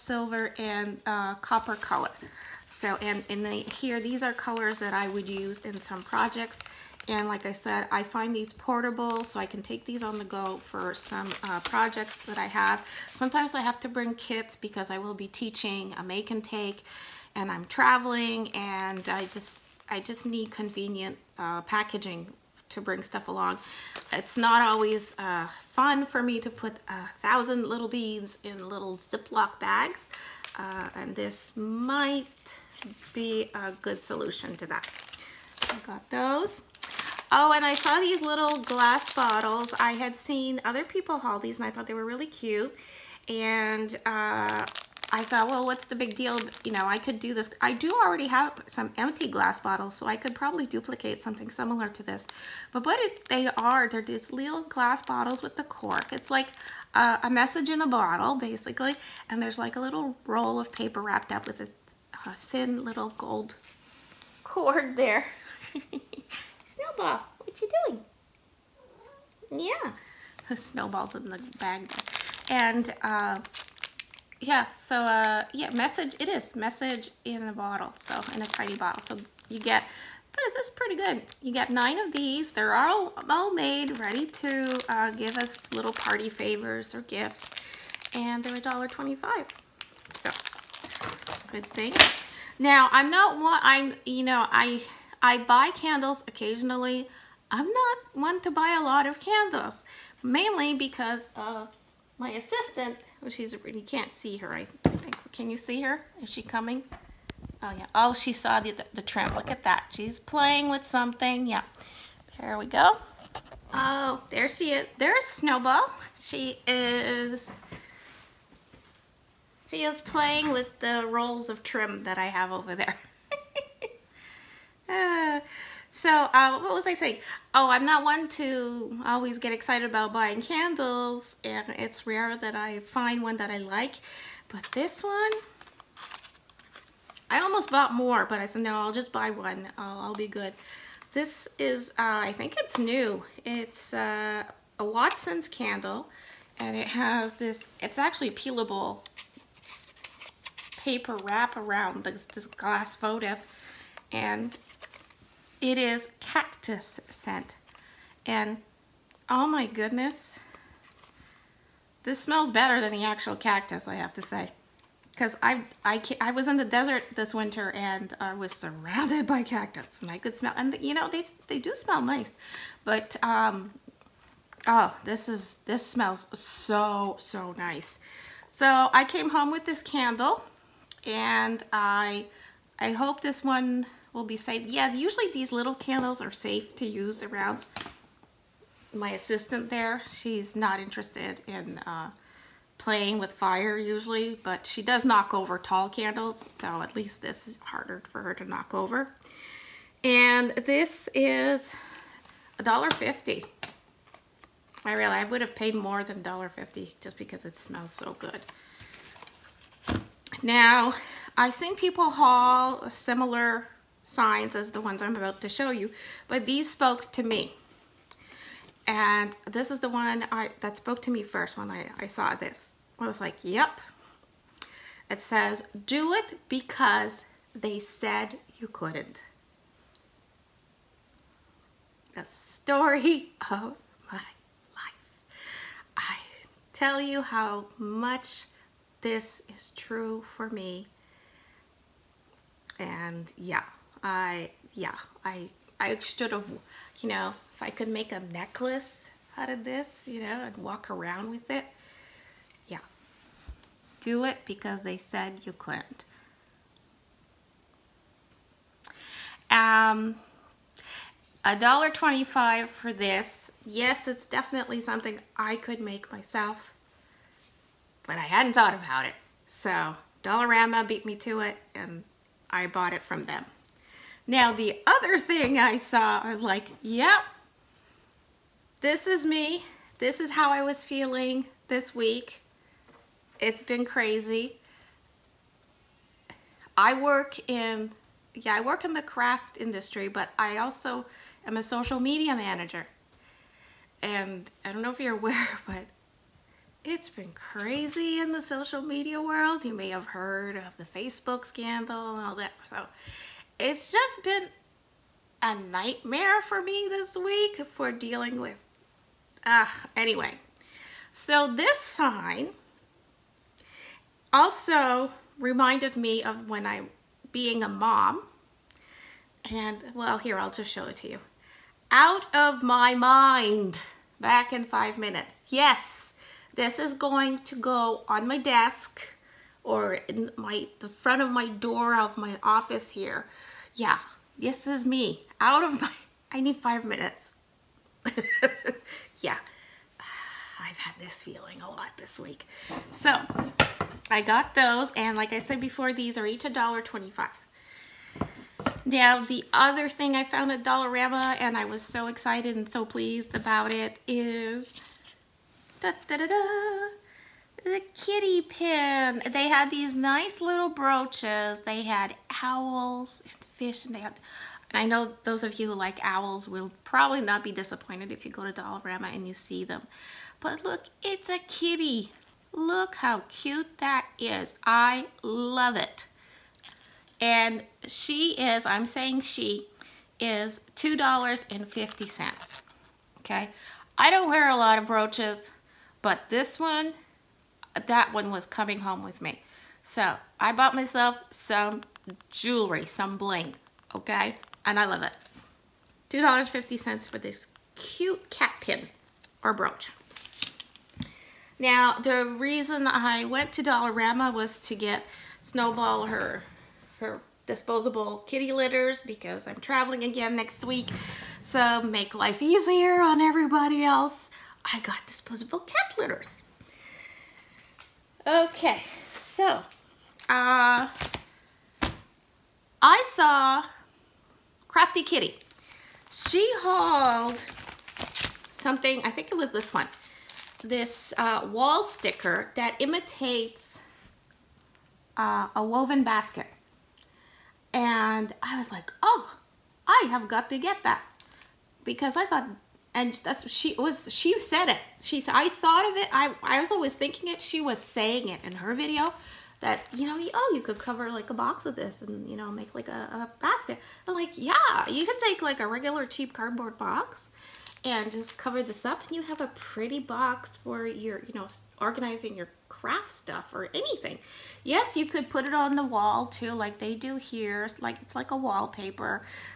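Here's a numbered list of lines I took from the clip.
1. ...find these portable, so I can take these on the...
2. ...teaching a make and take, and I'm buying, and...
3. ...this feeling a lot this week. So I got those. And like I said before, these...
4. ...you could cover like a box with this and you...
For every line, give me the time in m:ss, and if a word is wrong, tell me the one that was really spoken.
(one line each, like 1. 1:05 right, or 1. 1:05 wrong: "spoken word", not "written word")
1. 0:08 right
2. 0:15 wrong: "traveling", not "buying"
3. 5:40 right
4. 7:30 right.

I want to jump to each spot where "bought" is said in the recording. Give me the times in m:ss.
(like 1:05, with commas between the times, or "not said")
2:17, 4:32, 6:30.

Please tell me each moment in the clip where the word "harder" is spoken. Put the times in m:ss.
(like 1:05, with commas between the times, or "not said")
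3:17.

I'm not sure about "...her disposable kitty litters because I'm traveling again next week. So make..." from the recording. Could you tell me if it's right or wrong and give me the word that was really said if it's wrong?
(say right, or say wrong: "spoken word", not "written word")
right.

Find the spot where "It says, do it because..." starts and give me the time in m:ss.
3:45.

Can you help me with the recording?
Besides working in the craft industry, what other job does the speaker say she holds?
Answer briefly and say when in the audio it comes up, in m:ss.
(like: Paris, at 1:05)
Social media manager, at 4:51.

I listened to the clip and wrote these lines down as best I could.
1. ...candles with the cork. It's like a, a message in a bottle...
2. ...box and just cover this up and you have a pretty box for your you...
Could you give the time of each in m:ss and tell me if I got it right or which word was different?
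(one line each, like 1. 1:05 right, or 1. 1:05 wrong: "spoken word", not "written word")
1. 0:55 wrong: "bottles", not "candles"
2. 7:36 right.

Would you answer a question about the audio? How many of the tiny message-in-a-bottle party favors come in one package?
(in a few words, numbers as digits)
9.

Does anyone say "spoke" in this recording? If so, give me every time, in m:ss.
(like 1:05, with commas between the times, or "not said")
3:36, 3:40.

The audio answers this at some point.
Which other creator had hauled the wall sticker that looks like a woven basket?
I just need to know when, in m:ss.
7:04.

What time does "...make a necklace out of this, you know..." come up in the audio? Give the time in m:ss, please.
4:07.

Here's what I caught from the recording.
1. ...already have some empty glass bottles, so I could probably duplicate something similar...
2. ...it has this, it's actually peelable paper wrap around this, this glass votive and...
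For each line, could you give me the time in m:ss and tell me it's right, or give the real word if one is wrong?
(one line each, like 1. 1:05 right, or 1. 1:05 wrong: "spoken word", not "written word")
1. 0:47 right
2. 2:26 right.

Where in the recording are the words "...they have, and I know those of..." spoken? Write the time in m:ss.
6:03.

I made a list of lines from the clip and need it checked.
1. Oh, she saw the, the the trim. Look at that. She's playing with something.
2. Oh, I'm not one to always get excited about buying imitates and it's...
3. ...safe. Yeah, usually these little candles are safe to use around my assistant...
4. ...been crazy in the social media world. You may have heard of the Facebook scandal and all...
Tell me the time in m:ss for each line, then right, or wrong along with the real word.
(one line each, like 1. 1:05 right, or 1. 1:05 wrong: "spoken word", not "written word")
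1. 1:47 right
2. 2:07 wrong: "candles", not "imitates"
3. 3:04 right
4. 4:57 right.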